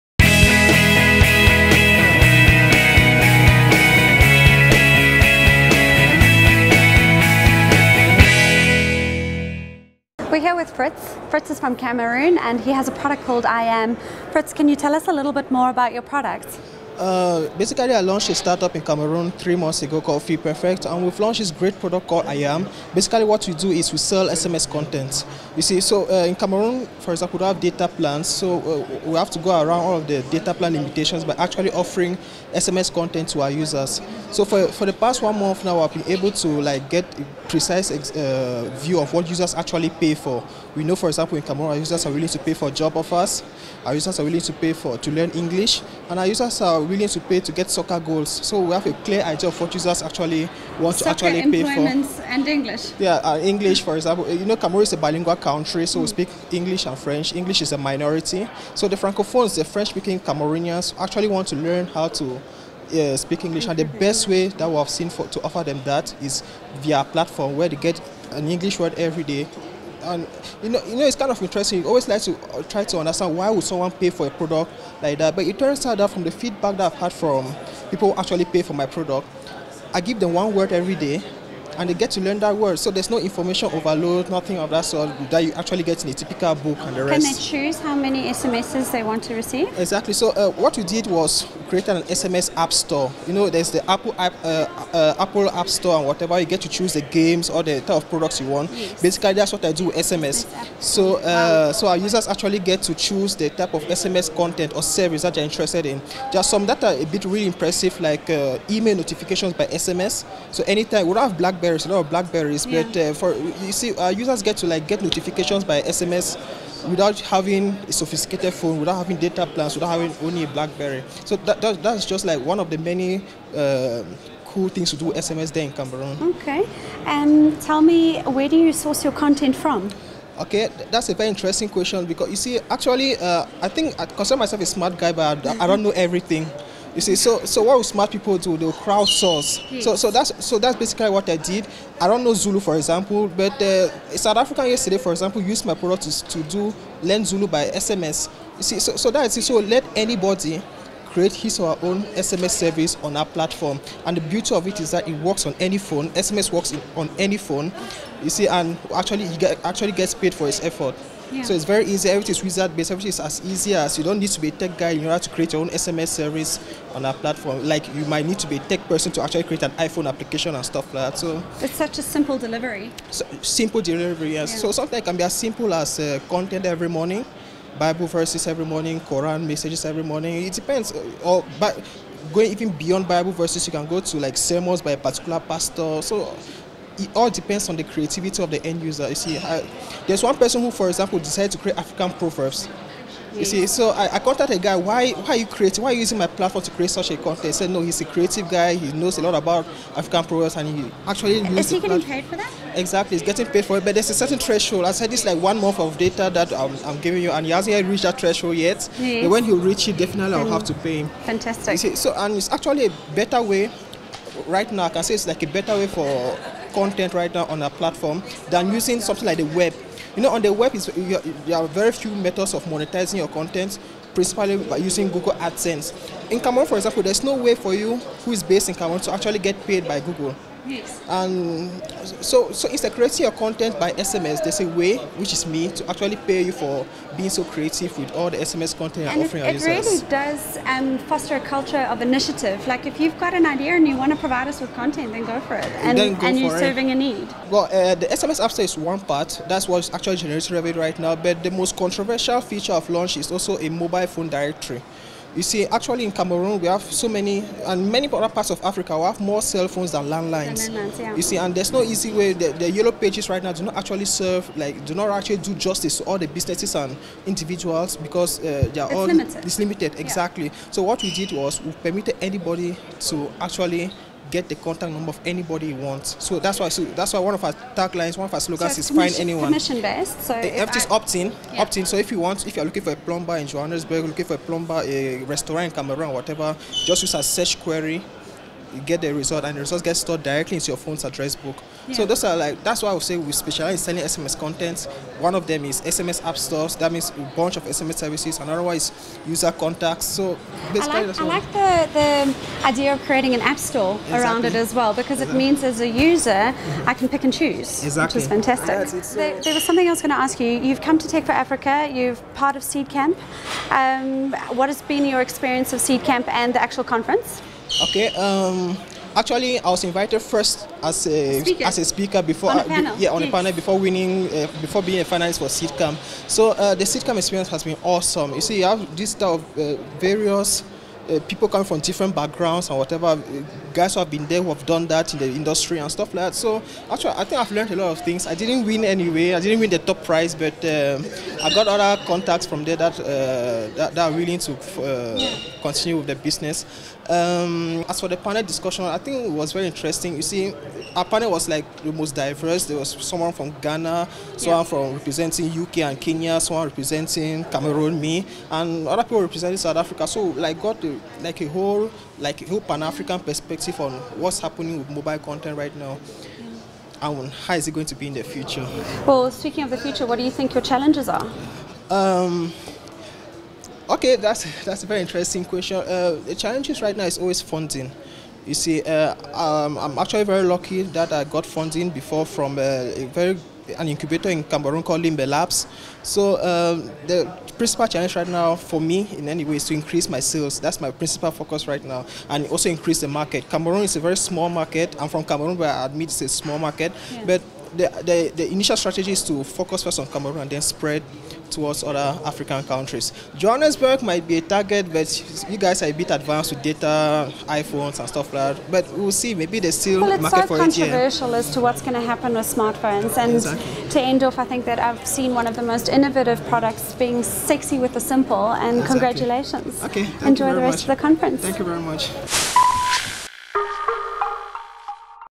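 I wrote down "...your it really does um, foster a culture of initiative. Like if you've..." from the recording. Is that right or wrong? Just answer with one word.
right.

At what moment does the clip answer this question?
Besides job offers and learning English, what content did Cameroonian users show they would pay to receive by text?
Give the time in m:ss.
0:47.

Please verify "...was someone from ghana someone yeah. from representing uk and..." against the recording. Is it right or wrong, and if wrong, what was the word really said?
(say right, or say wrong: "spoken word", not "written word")
right.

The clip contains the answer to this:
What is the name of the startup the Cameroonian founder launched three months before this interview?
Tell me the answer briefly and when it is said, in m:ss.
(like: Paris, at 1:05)
Fee Perfect, at 0:20.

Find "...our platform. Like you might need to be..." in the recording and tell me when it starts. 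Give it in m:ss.
2:47.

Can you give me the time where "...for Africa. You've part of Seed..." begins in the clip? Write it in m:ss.
5:11.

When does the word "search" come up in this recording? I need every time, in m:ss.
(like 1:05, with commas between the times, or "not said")
4:47.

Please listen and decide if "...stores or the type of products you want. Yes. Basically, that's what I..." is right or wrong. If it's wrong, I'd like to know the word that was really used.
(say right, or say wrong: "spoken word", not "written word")
wrong: "games", not "stores".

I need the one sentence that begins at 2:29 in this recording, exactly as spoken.
So let anybody create his or her own SMS service on our platform.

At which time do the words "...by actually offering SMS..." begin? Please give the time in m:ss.
0:31.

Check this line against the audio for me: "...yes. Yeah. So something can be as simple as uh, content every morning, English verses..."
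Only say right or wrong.
wrong.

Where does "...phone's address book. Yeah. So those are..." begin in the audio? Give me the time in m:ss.
4:50.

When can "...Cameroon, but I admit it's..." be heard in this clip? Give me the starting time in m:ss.
6:35.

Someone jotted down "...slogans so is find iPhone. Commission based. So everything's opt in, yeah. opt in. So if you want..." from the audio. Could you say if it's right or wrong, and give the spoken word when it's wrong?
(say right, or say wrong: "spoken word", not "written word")
wrong: "anyone", not "iPhone".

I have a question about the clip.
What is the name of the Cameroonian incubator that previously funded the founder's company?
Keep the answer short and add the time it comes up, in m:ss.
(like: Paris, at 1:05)
Limbe Labs, at 6:25.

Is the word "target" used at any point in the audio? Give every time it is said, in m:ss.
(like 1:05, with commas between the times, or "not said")
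6:44.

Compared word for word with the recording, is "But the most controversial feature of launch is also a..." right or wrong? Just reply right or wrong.
right.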